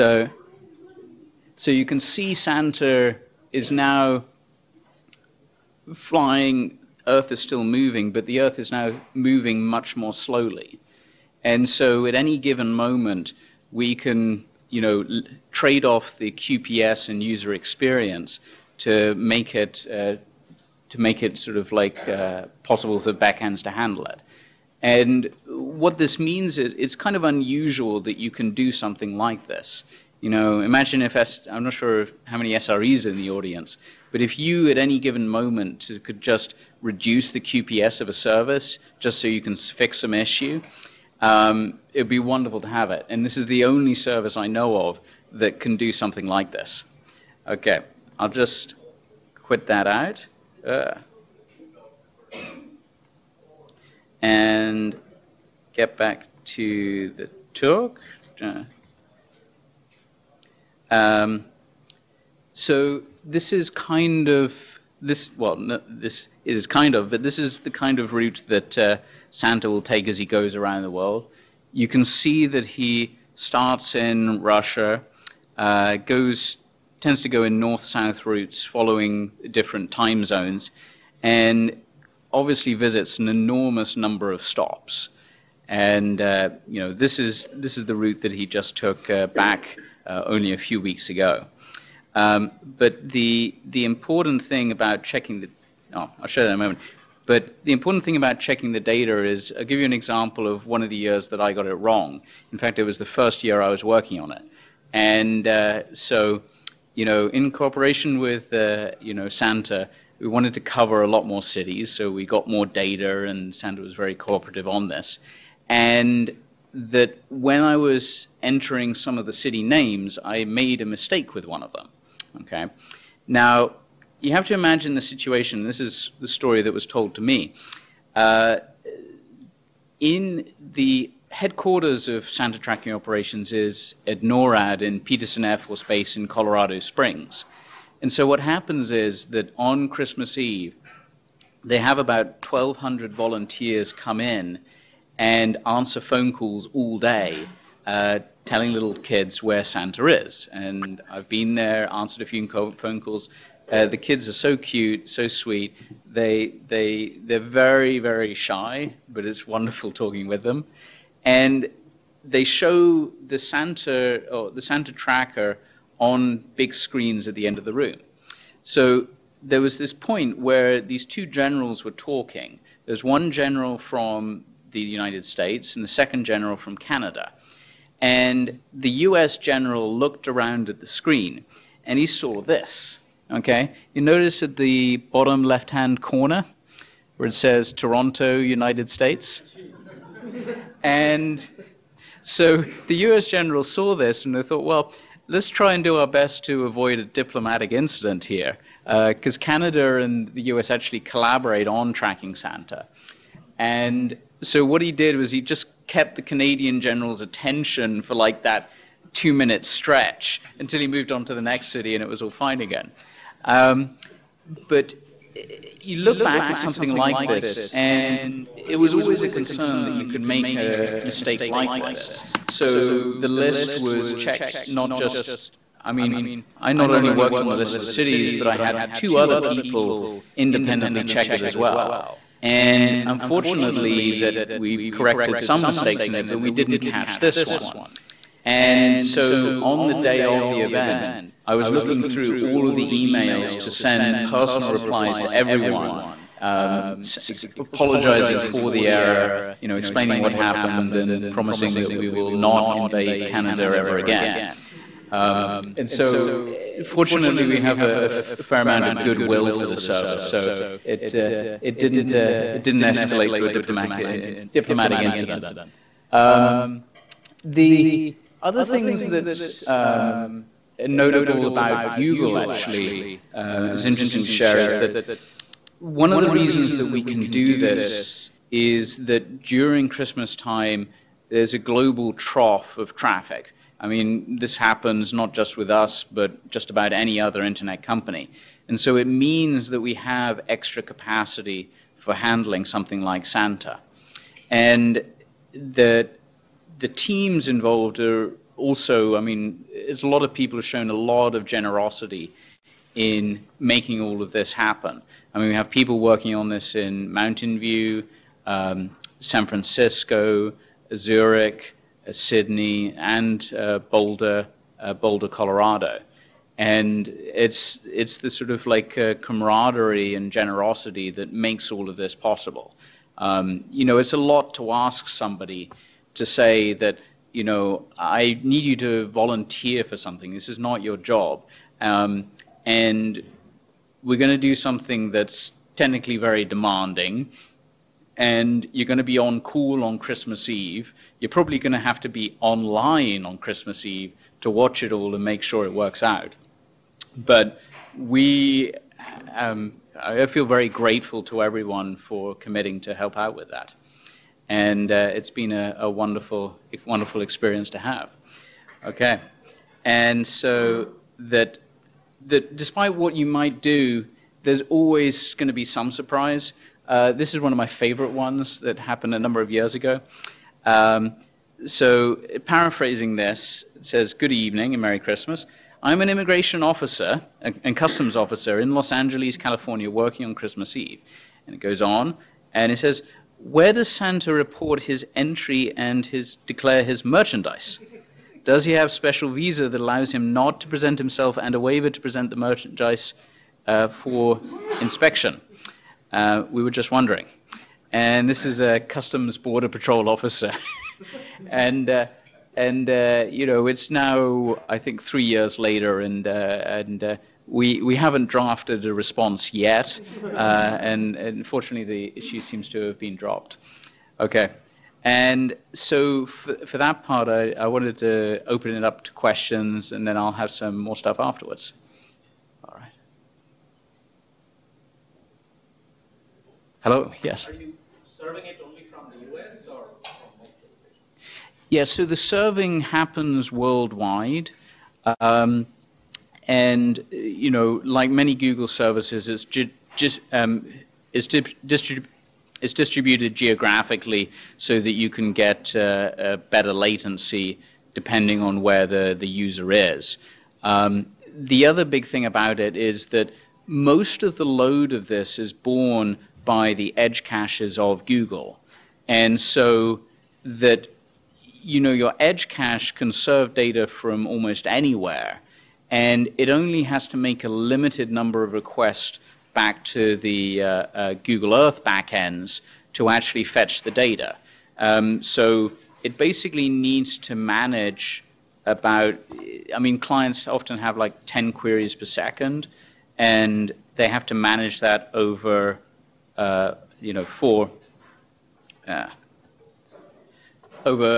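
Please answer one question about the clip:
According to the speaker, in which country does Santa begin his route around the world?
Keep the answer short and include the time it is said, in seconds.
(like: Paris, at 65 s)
Russia, at 74 s.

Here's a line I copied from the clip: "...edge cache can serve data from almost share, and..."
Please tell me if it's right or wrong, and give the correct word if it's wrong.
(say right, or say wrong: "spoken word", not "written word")
wrong: "anywhere", not "share".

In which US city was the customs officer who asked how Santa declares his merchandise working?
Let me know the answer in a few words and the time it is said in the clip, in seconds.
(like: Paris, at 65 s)
Los Angeles, at 378 s.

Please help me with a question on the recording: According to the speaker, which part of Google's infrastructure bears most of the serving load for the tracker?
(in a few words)
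edge caches.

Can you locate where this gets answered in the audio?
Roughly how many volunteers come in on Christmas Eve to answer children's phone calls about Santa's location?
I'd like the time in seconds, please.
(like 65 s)
142 s.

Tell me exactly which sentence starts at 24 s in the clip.
And what this means is it's kind of unusual that you can do something like this.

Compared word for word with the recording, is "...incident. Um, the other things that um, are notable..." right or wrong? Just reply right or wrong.
right.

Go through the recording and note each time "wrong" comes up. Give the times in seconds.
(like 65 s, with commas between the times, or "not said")
101 s.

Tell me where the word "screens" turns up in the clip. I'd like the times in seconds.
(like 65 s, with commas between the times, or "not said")
166 s, 180 s.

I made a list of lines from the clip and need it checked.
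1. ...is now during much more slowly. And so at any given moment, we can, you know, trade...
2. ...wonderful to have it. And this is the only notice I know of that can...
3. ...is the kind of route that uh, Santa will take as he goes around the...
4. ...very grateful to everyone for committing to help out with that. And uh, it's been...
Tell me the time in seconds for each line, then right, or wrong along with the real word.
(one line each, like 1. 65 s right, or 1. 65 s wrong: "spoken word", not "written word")
1. 8 s wrong: "moving", not "during"
2. 42 s wrong: "service", not "notice"
3. 67 s right
4. 350 s right.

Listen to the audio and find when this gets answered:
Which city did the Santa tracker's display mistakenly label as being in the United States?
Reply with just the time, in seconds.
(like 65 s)
187 s.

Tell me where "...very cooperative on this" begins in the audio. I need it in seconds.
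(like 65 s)
113 s.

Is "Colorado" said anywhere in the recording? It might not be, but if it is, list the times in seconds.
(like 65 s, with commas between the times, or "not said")
136 s, 315 s.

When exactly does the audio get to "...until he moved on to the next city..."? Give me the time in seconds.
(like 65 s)
210 s.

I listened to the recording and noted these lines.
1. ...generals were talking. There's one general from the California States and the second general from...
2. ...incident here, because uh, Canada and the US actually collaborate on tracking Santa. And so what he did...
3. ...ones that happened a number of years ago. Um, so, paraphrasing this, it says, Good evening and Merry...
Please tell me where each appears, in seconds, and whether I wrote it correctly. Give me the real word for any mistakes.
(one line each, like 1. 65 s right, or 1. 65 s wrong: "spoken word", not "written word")
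1. 171 s wrong: "United", not "California"
2. 197 s right
3. 368 s right.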